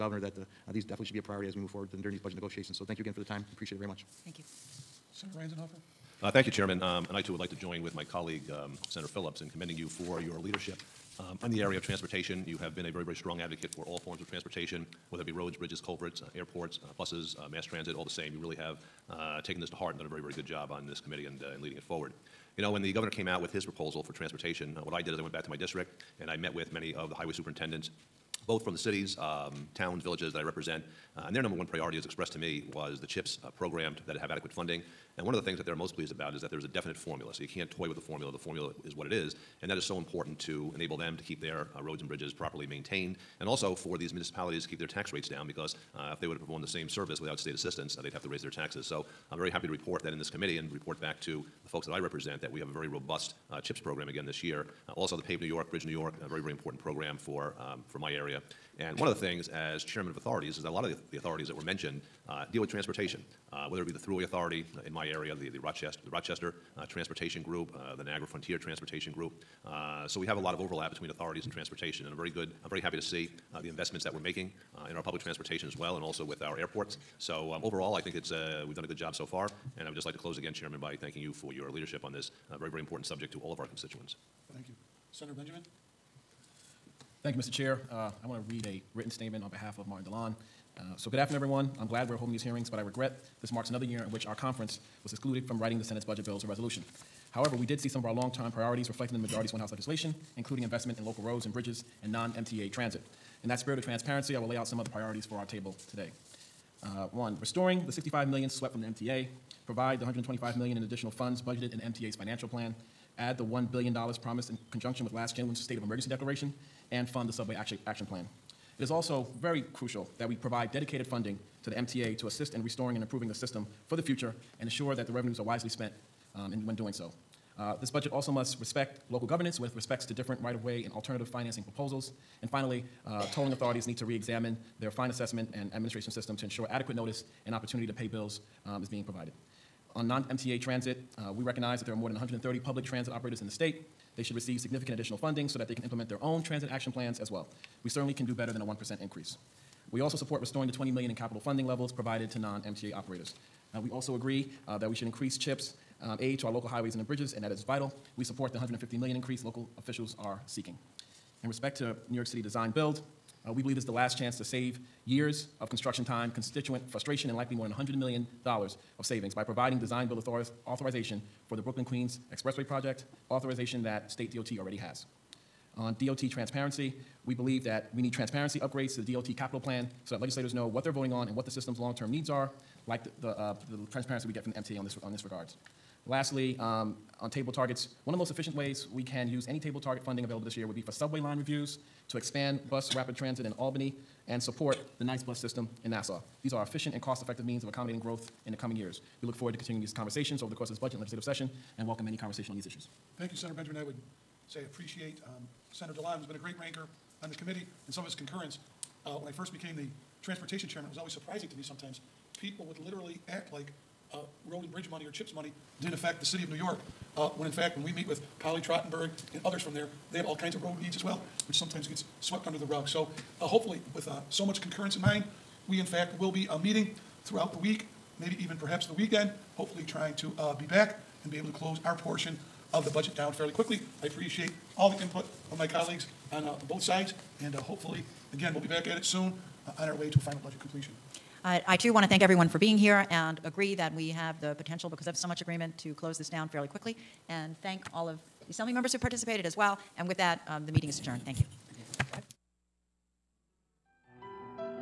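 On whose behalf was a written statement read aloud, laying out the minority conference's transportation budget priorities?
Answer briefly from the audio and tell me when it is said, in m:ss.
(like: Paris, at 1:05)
Martin Dilan, at 1:29.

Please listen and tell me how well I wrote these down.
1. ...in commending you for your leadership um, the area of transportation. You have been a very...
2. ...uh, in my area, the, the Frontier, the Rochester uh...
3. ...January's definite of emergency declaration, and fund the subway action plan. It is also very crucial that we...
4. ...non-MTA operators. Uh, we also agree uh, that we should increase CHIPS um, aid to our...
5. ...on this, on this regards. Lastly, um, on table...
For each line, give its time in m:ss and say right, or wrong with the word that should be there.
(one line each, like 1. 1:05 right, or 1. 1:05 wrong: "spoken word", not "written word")
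1. 0:09 right
2. 1:04 wrong: "Rochester", not "Frontier"
3. 1:55 wrong: "state", not "definite"
4. 2:32 right
5. 3:04 right.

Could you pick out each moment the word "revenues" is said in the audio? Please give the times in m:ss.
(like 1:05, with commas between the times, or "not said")
2:05.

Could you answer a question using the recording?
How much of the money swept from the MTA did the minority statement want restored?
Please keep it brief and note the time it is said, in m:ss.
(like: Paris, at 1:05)
65 million, at 1:47.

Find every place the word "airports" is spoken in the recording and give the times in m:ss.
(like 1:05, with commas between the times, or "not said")
0:16, 1:16.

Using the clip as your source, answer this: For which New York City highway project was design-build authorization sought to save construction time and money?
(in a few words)
Brooklyn Queens Expressway.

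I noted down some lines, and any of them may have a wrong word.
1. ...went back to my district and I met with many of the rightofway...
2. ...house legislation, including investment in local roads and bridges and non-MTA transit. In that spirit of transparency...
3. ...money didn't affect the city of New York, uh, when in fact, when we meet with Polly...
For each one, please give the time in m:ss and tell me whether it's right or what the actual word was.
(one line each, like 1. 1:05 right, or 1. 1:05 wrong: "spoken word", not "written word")
1. 0:25 wrong: "highway", not "rightofway"
2. 1:39 right
3. 3:35 right.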